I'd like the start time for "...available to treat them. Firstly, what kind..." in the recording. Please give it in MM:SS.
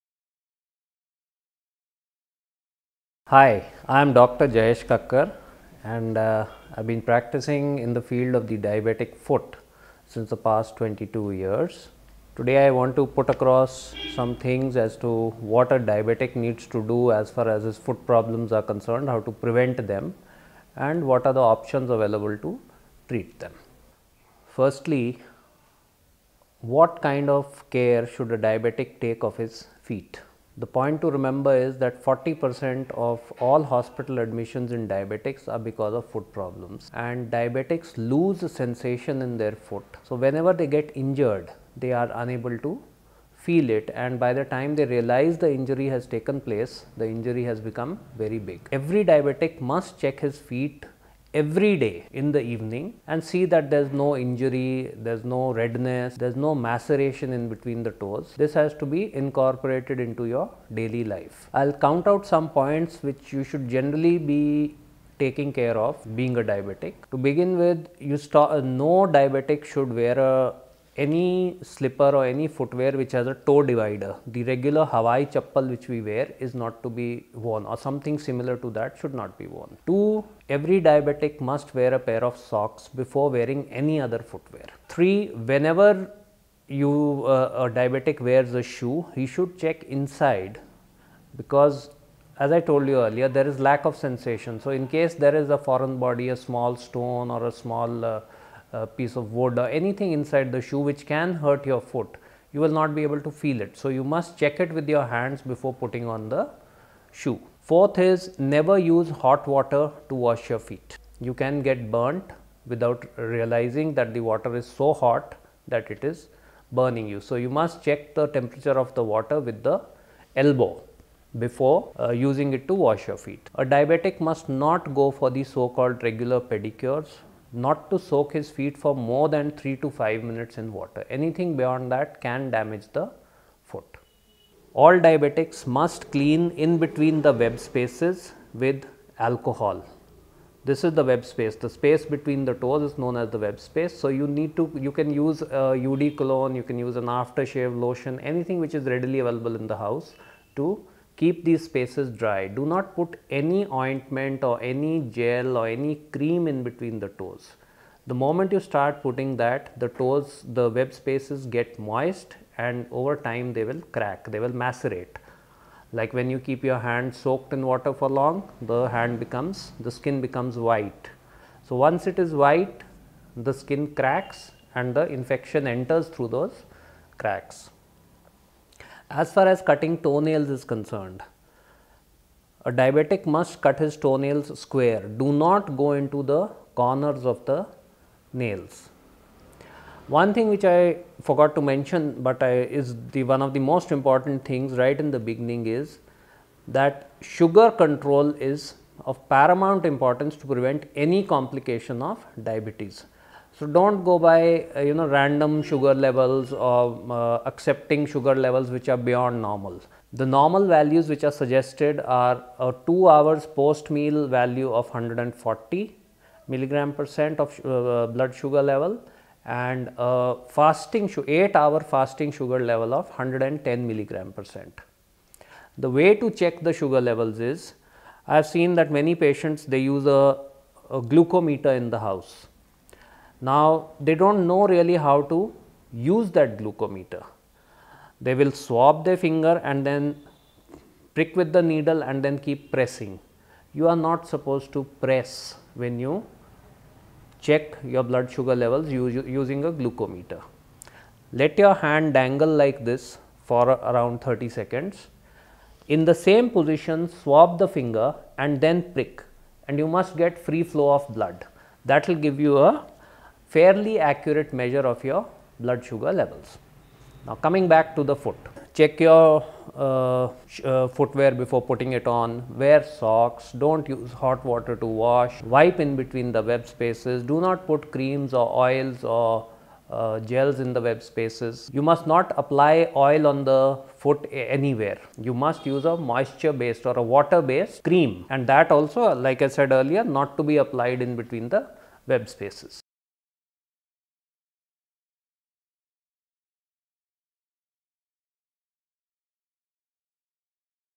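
00:21.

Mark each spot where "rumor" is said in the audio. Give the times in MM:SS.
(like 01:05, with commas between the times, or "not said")
not said.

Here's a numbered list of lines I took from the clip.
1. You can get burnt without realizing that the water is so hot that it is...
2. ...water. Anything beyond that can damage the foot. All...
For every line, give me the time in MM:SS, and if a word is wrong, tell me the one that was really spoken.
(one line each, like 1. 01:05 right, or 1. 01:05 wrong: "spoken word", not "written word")
1. 01:51 right
2. 02:10 right.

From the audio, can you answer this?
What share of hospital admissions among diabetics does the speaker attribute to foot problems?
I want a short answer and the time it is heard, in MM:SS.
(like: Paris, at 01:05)
40 percent, at 00:32.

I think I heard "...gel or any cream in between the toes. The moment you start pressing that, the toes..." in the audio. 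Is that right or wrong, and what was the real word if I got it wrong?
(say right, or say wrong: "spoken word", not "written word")
wrong: "putting", not "pressing".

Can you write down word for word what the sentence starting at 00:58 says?
This has to be incorporated into your daily life.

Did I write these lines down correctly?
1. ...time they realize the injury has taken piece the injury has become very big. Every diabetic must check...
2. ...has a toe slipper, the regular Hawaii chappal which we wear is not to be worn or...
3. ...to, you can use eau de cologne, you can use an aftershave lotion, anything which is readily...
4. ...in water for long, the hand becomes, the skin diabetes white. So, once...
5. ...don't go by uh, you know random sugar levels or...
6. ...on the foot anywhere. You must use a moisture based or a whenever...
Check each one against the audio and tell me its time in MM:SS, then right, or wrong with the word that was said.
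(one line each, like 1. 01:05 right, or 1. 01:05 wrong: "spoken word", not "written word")
1. 00:44 wrong: "place", not "piece"
2. 01:13 wrong: "divider", not "slipper"
3. 02:24 right
4. 02:47 wrong: "becomes", not "diabetes"
5. 03:23 right
6. 04:43 wrong: "water", not "whenever".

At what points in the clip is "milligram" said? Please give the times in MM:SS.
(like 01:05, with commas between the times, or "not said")
03:36, 03:43.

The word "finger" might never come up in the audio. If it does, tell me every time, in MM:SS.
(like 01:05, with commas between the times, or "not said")
03:59, 04:17.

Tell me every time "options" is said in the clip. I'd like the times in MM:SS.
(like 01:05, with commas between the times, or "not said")
00:21.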